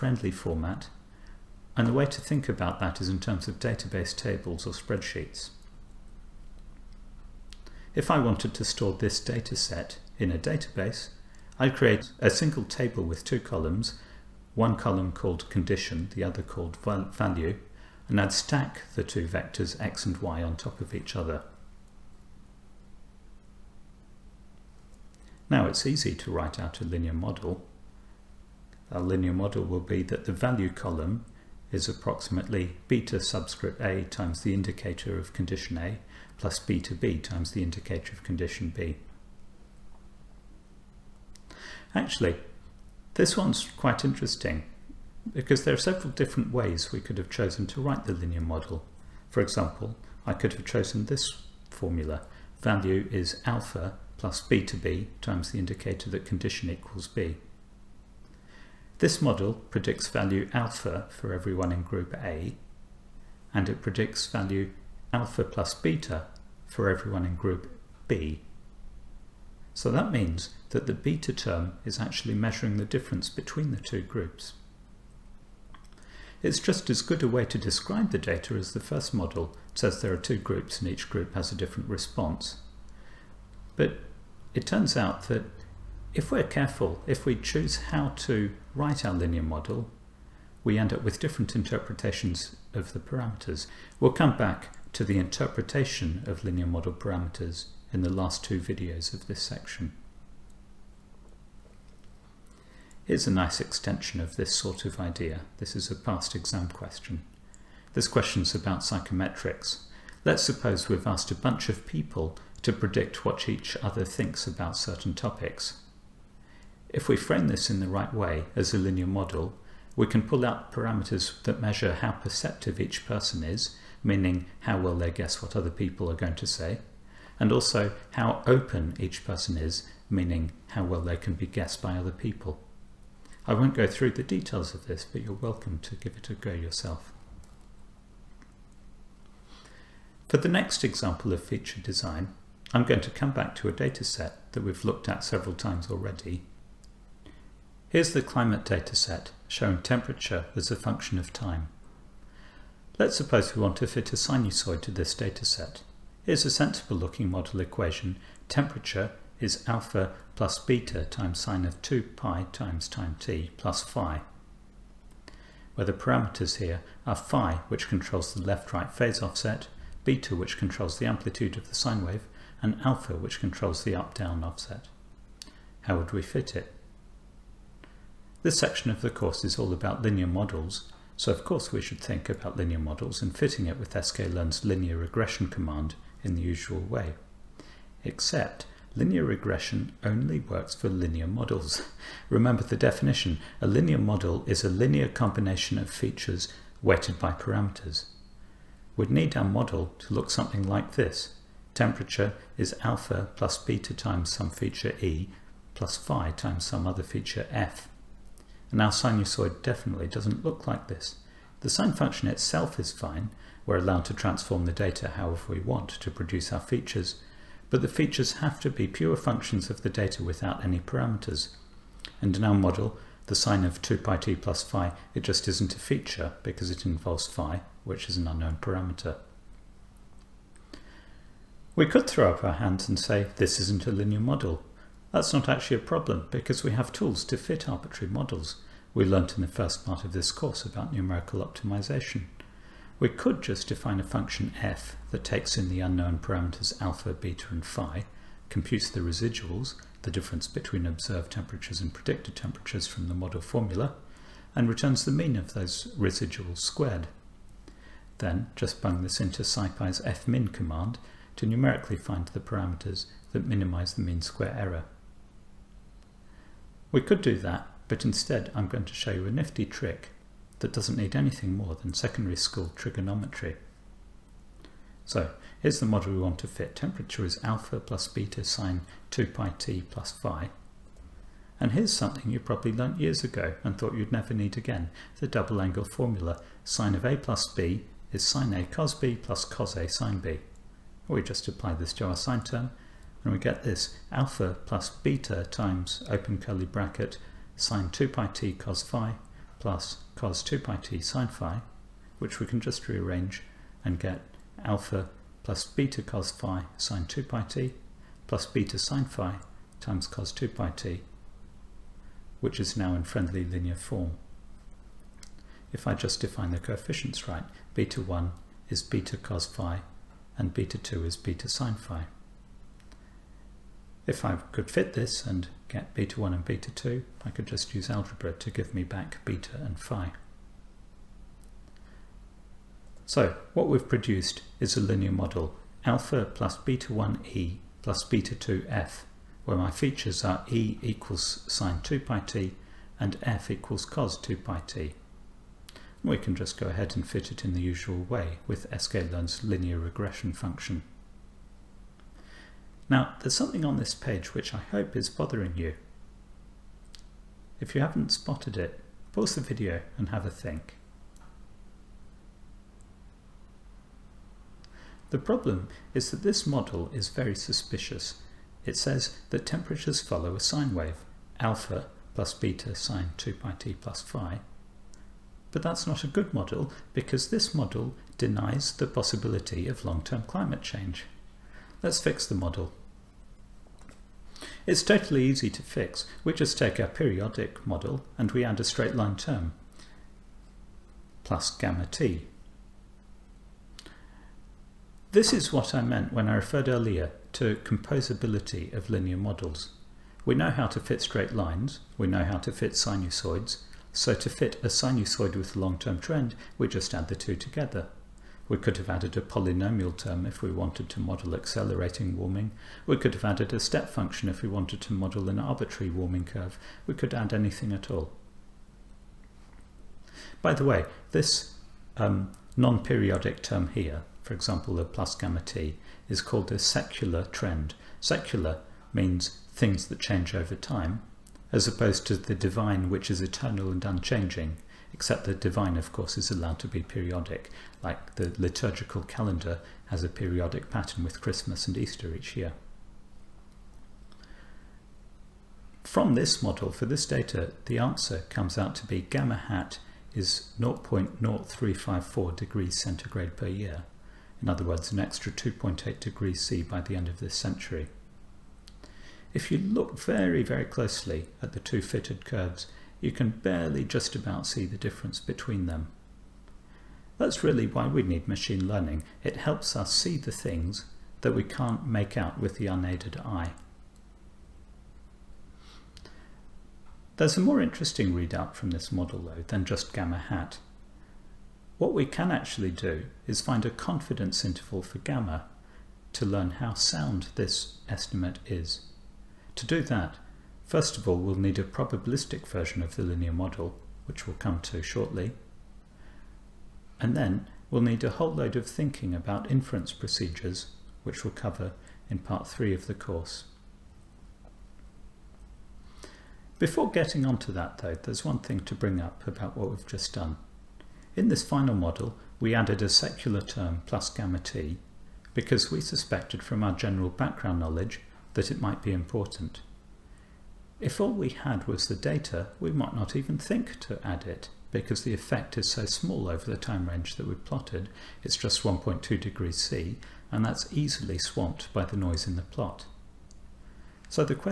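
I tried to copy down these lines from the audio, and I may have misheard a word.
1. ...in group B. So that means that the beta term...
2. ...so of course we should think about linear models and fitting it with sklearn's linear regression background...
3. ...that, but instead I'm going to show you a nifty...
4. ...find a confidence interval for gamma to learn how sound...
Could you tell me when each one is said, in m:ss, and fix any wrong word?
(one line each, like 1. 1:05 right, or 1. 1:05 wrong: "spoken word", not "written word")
1. 1:07 right
2. 3:01 wrong: "command", not "background"
3. 4:27 right
4. 8:03 right.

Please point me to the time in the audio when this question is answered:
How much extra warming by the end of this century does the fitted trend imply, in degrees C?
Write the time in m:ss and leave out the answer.
7:35.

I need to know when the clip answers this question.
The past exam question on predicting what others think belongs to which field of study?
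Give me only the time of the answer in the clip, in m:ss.
1:48.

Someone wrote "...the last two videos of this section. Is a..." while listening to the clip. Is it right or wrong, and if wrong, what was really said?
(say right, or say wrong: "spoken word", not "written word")
right.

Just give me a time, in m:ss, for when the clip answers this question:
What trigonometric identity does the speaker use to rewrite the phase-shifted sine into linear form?
4:45.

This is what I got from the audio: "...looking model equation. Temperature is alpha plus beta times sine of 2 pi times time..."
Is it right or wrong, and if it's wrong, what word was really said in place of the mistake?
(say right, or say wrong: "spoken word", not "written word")
right.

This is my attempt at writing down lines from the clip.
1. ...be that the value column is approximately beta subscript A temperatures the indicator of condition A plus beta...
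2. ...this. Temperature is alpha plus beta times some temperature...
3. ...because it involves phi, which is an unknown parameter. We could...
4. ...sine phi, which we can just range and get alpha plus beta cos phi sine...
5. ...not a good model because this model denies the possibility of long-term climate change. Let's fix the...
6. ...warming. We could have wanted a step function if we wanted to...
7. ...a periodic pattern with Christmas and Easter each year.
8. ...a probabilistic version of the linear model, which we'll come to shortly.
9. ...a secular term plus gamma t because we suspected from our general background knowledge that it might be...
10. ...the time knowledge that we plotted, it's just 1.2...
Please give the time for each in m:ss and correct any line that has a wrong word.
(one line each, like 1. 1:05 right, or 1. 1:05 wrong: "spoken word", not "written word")
1. 0:29 wrong: "times", not "temperatures"
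2. 3:20 wrong: "feature", not "temperature"
3. 3:46 right
4. 5:00 wrong: "rearrange", not "range"
5. 6:15 right
6. 6:52 wrong: "added", not "wanted"
7. 7:20 right
8. 8:11 right
9. 8:32 right
10. 8:46 wrong: "range", not "knowledge".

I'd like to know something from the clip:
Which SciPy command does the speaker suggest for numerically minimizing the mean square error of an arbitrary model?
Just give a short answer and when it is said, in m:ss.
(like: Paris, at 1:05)
fmin, at 4:19.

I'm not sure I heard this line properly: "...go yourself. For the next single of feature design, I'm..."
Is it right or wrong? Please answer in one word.
wrong.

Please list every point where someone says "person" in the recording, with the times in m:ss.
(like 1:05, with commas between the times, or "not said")
2:03, 2:09.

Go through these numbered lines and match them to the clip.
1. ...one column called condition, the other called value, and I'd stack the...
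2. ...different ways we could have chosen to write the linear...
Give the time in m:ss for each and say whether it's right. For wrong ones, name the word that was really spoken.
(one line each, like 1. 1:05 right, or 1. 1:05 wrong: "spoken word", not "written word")
1. 0:14 right
2. 0:46 right.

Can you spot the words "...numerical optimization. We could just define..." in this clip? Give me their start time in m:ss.
4:00.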